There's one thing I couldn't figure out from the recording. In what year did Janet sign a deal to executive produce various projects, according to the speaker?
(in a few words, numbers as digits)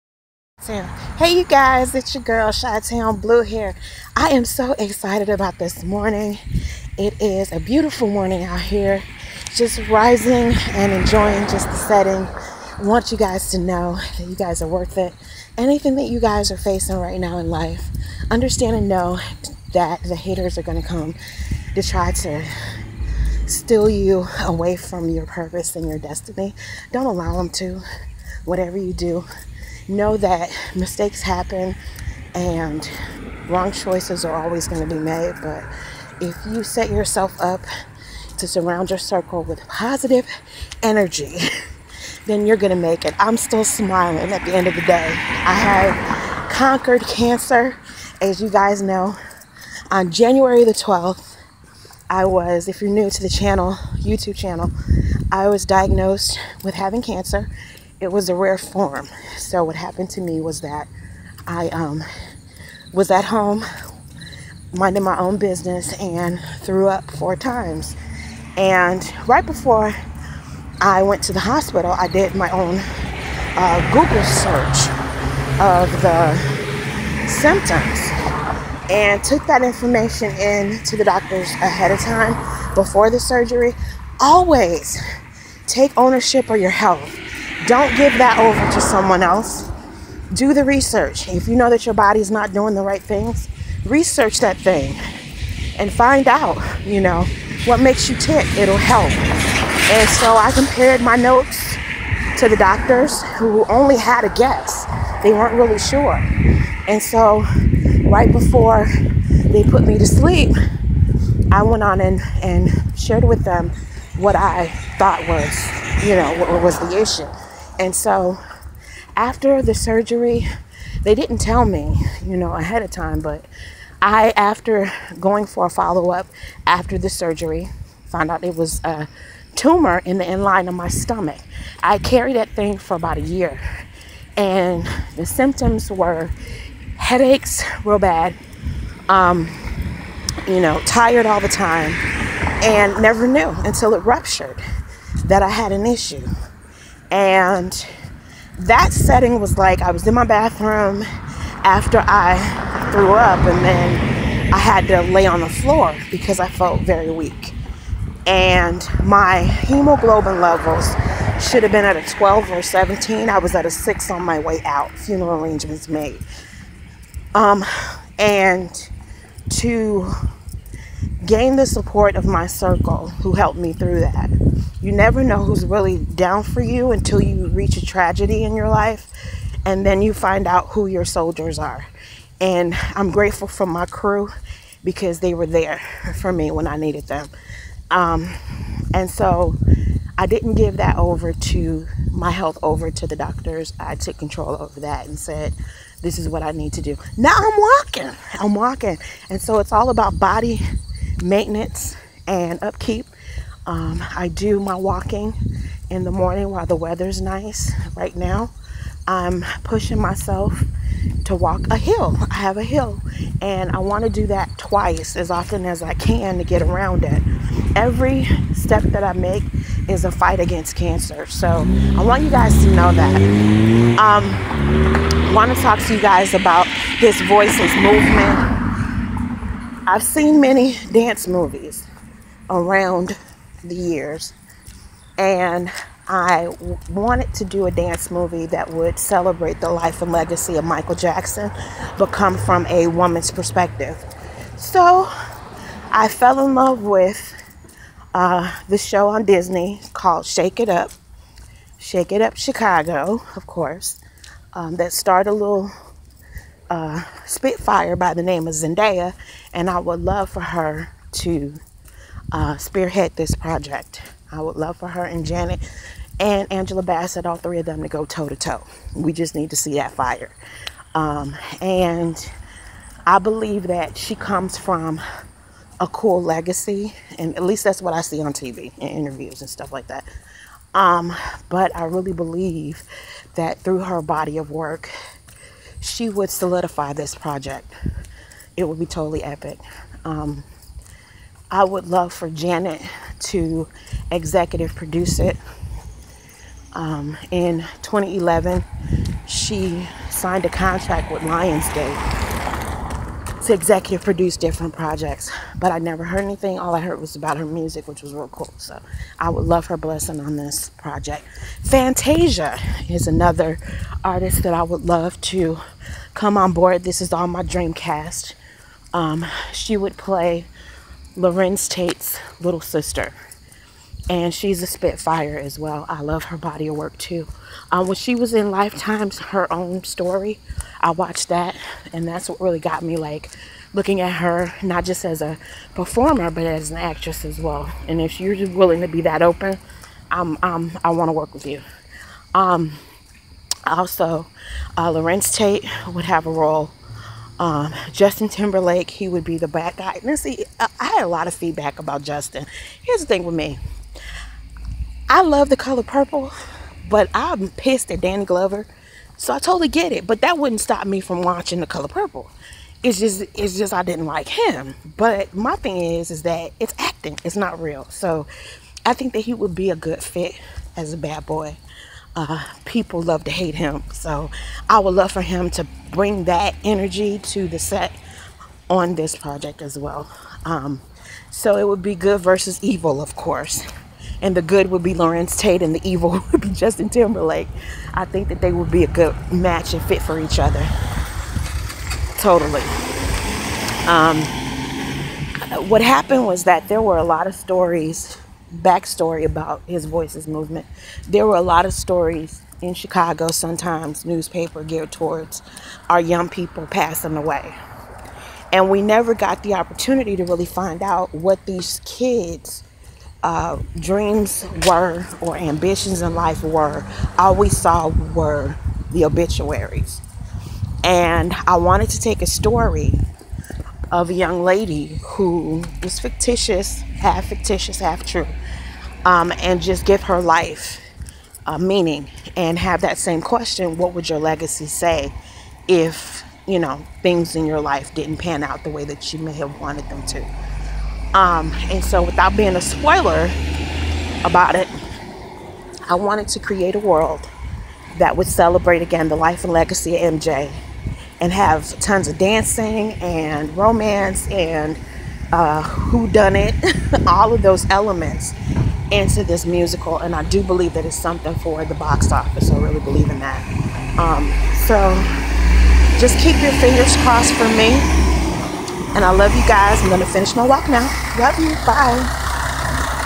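2011.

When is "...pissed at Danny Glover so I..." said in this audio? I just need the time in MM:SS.
05:57.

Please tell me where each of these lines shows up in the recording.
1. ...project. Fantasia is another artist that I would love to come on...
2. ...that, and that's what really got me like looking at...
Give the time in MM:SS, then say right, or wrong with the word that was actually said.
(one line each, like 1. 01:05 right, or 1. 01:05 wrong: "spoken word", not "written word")
1. 05:10 right
2. 05:31 right.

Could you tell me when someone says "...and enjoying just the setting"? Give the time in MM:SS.
00:10.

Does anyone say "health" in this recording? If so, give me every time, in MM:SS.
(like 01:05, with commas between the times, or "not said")
01:26, 03:12.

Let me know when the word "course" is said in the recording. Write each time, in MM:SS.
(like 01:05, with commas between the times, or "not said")
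04:13, 06:23.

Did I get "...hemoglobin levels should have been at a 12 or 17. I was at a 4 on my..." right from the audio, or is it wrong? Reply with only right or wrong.
wrong.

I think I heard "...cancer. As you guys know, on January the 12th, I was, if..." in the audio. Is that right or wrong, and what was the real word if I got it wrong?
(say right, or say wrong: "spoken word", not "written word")
right.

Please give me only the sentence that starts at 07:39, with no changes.
And I do believe that it's something for the box office.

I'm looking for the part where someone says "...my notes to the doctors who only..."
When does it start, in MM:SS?
01:40.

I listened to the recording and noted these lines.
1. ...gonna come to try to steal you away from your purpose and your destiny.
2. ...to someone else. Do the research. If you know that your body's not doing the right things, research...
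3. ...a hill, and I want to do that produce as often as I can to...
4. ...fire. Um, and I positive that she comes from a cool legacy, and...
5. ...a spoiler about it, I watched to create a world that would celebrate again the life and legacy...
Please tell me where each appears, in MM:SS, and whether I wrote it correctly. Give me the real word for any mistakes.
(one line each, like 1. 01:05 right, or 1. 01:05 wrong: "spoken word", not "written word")
1. 00:20 right
2. 01:28 right
3. 03:32 wrong: "twice", not "produce"
4. 04:29 wrong: "believe", not "positive"
5. 07:22 wrong: "wanted", not "watched".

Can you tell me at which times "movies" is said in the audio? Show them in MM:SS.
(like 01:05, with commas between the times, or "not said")
03:51, 03:58.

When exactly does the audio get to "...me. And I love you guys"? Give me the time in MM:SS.
07:47.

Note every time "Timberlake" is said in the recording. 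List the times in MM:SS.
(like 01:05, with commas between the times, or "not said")
05:48, 06:26.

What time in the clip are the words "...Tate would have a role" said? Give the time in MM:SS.
05:45.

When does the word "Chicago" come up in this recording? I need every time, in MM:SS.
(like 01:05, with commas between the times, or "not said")
04:12, 06:42.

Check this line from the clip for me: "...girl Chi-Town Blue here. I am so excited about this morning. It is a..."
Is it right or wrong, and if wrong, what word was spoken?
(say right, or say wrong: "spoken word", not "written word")
right.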